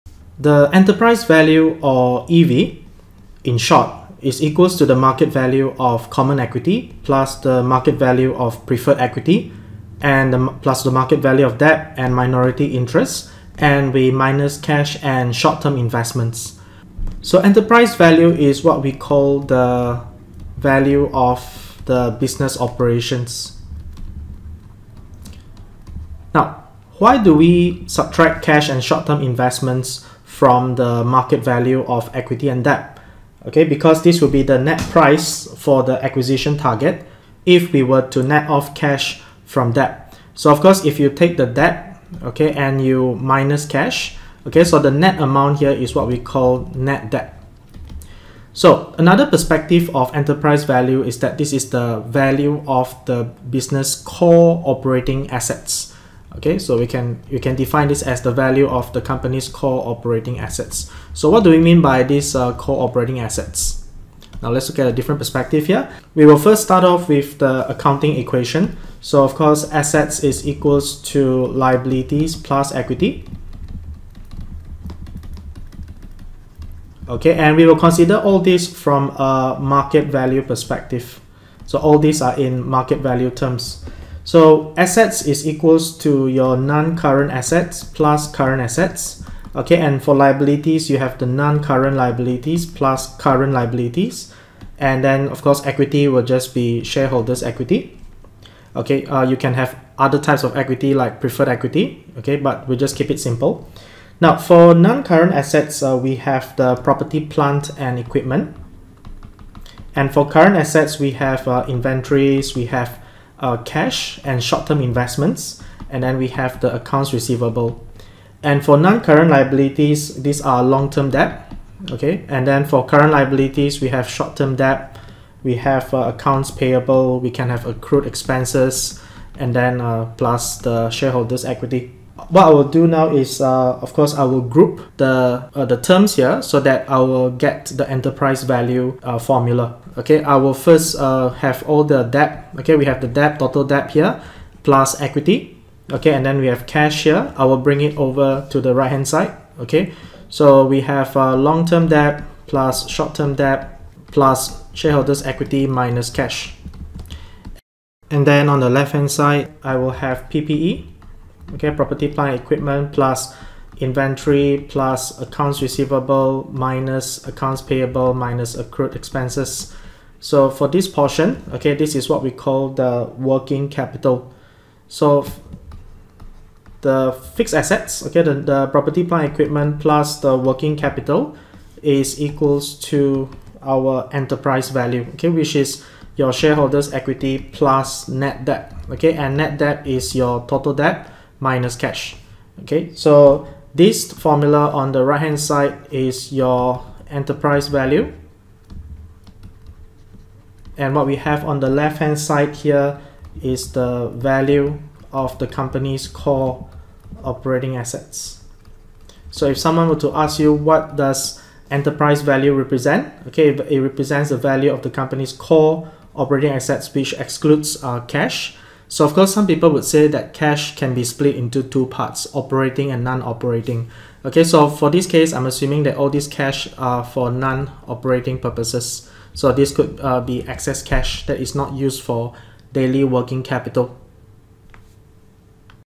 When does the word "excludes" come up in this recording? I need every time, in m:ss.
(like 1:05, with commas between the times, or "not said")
3:37.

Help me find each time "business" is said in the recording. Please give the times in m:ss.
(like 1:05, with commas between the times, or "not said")
0:22, 0:53.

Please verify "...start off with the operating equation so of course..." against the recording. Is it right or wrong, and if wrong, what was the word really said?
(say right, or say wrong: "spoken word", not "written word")
wrong: "accounting", not "operating".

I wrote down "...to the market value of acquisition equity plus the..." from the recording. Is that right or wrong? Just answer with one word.
wrong.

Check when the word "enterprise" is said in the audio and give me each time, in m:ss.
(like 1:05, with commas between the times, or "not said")
0:00, 0:17, 0:50, 2:17, 3:04, 3:17, 3:31.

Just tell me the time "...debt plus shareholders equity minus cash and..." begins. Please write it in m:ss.
2:33.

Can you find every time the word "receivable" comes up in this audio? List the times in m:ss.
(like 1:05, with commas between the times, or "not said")
1:57, 2:45.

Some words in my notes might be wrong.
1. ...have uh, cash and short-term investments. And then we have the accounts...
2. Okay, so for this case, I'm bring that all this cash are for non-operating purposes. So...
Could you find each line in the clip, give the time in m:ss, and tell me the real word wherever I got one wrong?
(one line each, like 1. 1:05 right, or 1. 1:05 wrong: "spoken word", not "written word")
1. 1:52 right
2. 3:44 wrong: "assuming", not "bring".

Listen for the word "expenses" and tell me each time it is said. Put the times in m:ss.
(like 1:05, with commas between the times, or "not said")
2:08, 2:48.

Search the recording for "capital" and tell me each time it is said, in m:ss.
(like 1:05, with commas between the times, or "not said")
2:53, 3:00, 3:53.